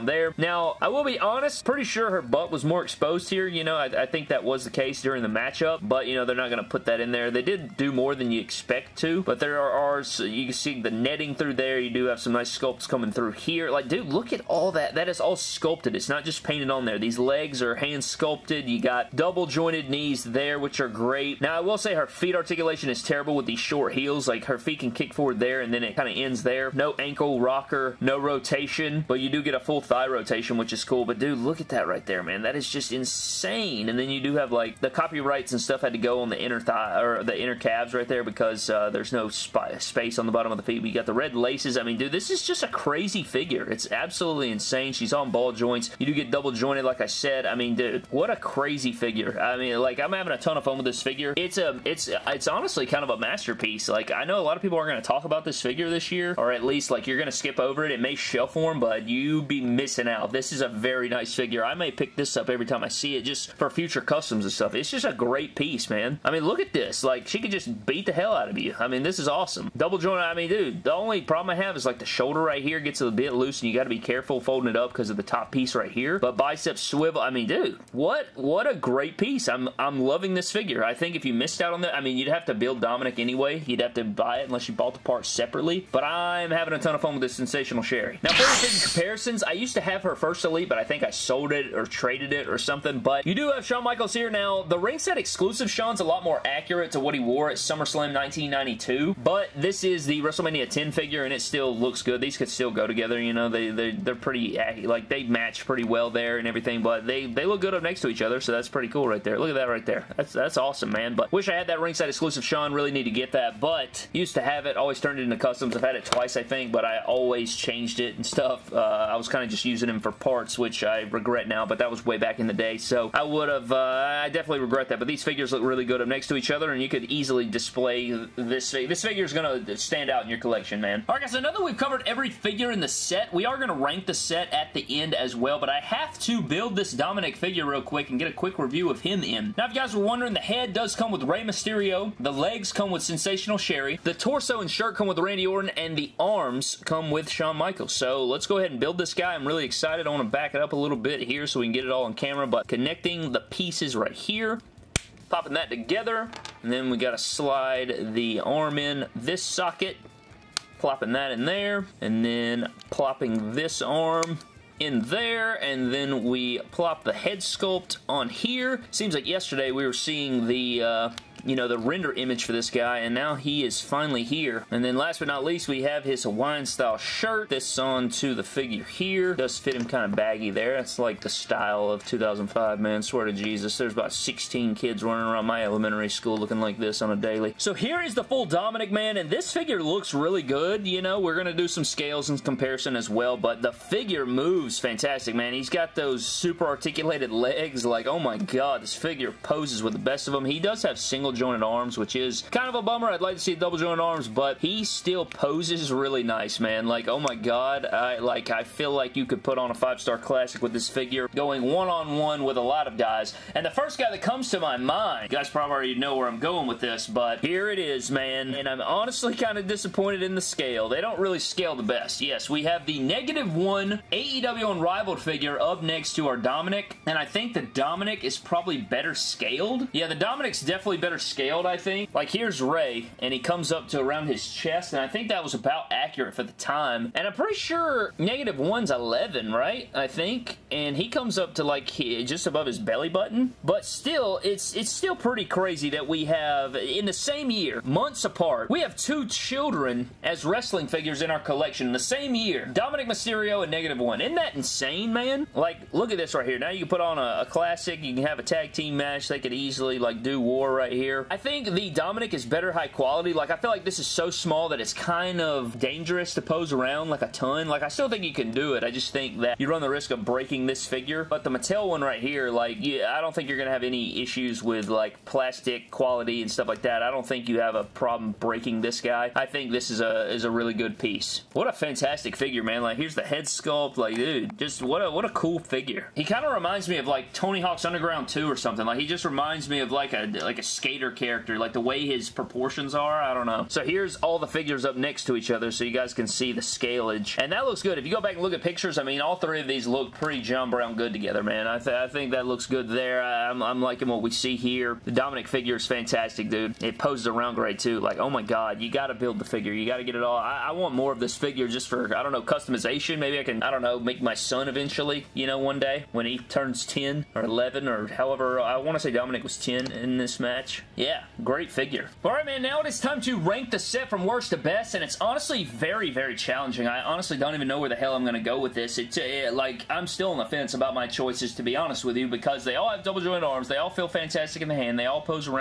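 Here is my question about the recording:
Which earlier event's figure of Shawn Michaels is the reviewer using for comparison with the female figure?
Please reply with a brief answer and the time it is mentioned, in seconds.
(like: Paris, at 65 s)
WrestleMania 10, at 100 s.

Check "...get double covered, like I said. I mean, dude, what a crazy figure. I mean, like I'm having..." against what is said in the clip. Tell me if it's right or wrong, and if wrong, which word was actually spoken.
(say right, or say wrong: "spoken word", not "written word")
wrong: "jointed", not "covered".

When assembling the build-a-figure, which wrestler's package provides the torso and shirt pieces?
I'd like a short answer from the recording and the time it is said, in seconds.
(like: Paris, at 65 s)
Randy Orton, at 145 s.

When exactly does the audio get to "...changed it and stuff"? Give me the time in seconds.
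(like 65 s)
117 s.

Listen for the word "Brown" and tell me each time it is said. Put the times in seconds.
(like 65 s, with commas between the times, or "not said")
300 s.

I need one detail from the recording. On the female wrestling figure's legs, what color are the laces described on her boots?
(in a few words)
Red.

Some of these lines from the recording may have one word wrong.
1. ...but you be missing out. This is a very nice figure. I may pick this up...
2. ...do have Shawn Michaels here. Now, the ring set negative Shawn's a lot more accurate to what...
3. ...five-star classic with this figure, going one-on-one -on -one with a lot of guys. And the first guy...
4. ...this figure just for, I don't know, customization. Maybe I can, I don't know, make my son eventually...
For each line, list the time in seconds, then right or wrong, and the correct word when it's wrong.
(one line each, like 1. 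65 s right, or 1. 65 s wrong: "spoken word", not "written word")
1. 58 s right
2. 93 s wrong: "exclusive", not "negative"
3. 209 s right
4. 311 s right.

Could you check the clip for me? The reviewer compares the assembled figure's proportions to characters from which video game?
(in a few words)
Tony Hawk's Underground 2.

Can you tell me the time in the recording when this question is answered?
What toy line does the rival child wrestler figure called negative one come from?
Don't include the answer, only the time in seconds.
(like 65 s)
224 s.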